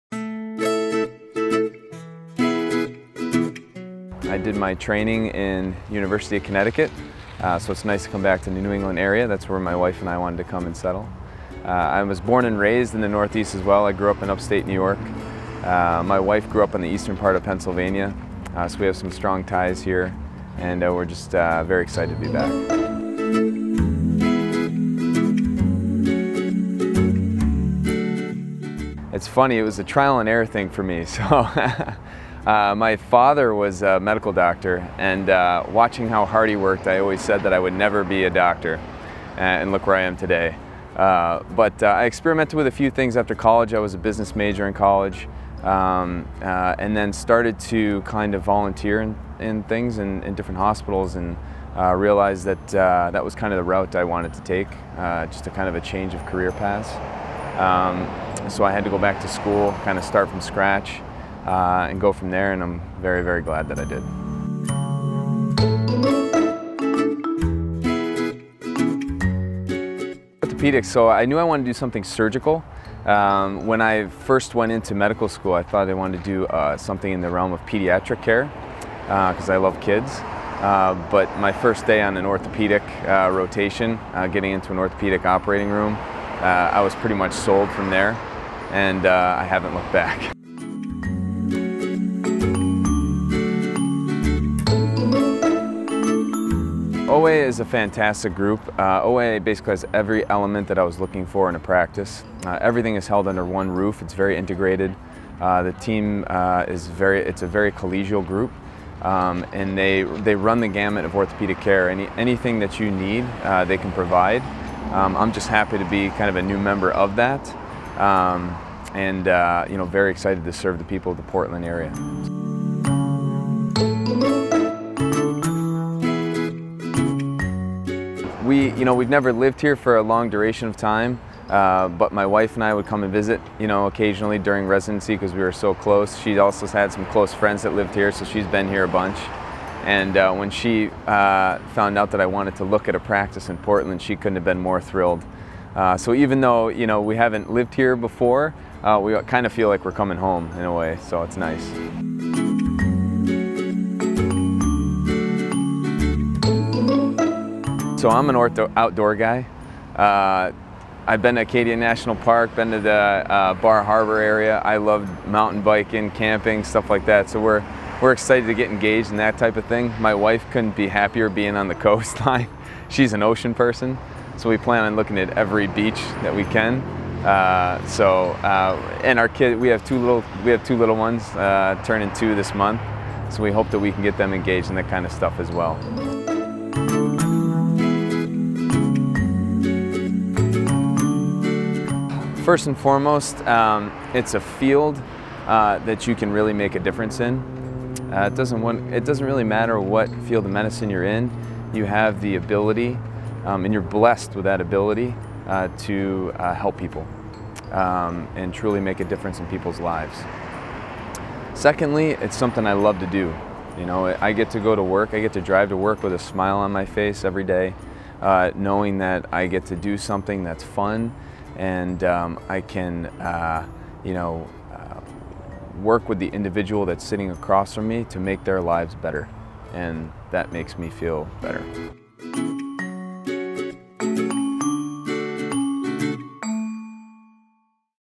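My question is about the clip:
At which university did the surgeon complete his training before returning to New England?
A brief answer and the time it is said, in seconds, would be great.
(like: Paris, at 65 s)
University of Connecticut, at 5 s.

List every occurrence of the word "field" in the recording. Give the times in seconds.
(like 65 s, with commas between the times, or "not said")
194 s, 200 s.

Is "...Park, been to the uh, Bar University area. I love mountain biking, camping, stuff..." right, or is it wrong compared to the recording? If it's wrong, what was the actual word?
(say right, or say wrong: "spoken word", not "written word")
wrong: "Harbor", not "University".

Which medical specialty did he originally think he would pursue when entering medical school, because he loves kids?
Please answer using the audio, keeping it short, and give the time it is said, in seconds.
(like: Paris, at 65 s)
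Pediatric care, at 77 s.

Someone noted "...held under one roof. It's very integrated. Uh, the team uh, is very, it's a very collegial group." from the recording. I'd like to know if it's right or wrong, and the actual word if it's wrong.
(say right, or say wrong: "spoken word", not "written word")
right.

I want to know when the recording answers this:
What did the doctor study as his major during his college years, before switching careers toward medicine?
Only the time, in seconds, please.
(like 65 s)
43 s.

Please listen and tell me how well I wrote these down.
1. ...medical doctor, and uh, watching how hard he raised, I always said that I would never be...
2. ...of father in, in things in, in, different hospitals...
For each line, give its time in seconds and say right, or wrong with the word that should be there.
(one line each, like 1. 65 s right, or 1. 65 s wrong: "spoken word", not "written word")
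1. 33 s wrong: "worked", not "raised"
2. 48 s wrong: "volunteer", not "father".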